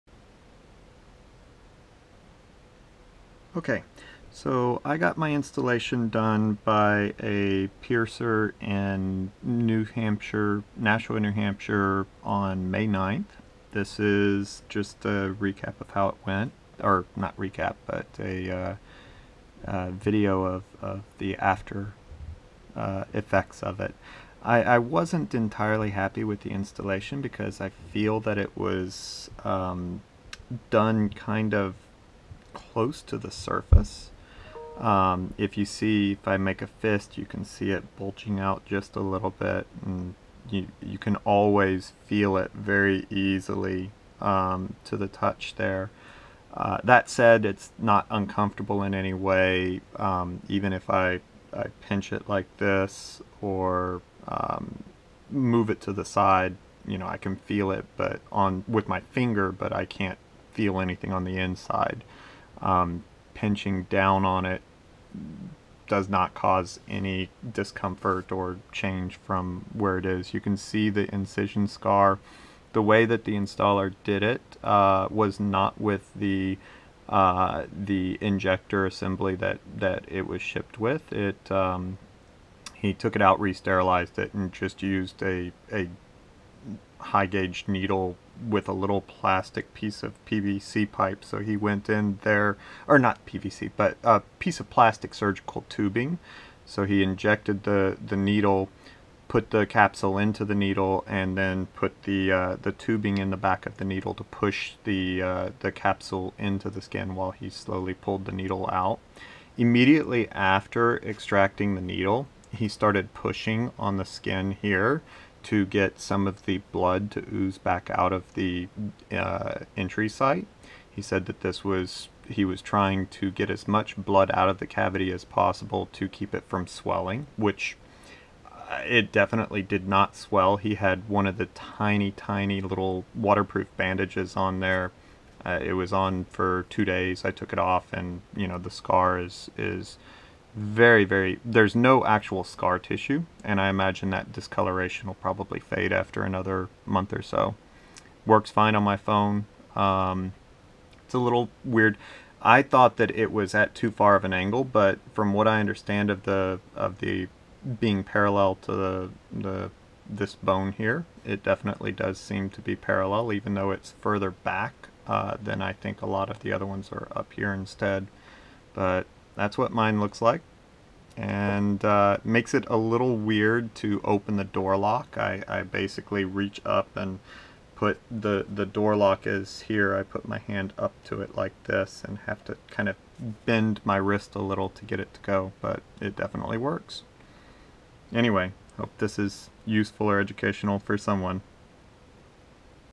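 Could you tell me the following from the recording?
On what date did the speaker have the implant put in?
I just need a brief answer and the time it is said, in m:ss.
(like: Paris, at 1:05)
May 9th, at 0:12.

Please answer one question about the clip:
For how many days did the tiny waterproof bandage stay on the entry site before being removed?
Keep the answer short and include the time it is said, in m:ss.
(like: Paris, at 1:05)
2, at 2:16.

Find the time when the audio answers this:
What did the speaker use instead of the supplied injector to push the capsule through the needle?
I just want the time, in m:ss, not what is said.
1:34.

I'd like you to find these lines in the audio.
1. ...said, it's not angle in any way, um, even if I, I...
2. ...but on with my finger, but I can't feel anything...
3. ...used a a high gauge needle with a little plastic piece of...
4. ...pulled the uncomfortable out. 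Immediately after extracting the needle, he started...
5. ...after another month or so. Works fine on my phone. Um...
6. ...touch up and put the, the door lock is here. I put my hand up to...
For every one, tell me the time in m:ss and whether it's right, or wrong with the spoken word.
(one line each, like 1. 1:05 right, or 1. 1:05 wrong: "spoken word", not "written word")
1. 0:47 wrong: "uncomfortable", not "angle"
2. 0:57 right
3. 1:24 right
4. 1:47 wrong: "needle", not "uncomfortable"
5. 2:25 right
6. 2:56 wrong: "reach", not "touch".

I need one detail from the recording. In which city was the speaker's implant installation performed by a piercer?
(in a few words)
Nashua, New Hampshire.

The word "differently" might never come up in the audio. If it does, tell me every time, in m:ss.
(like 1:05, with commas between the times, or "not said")
not said.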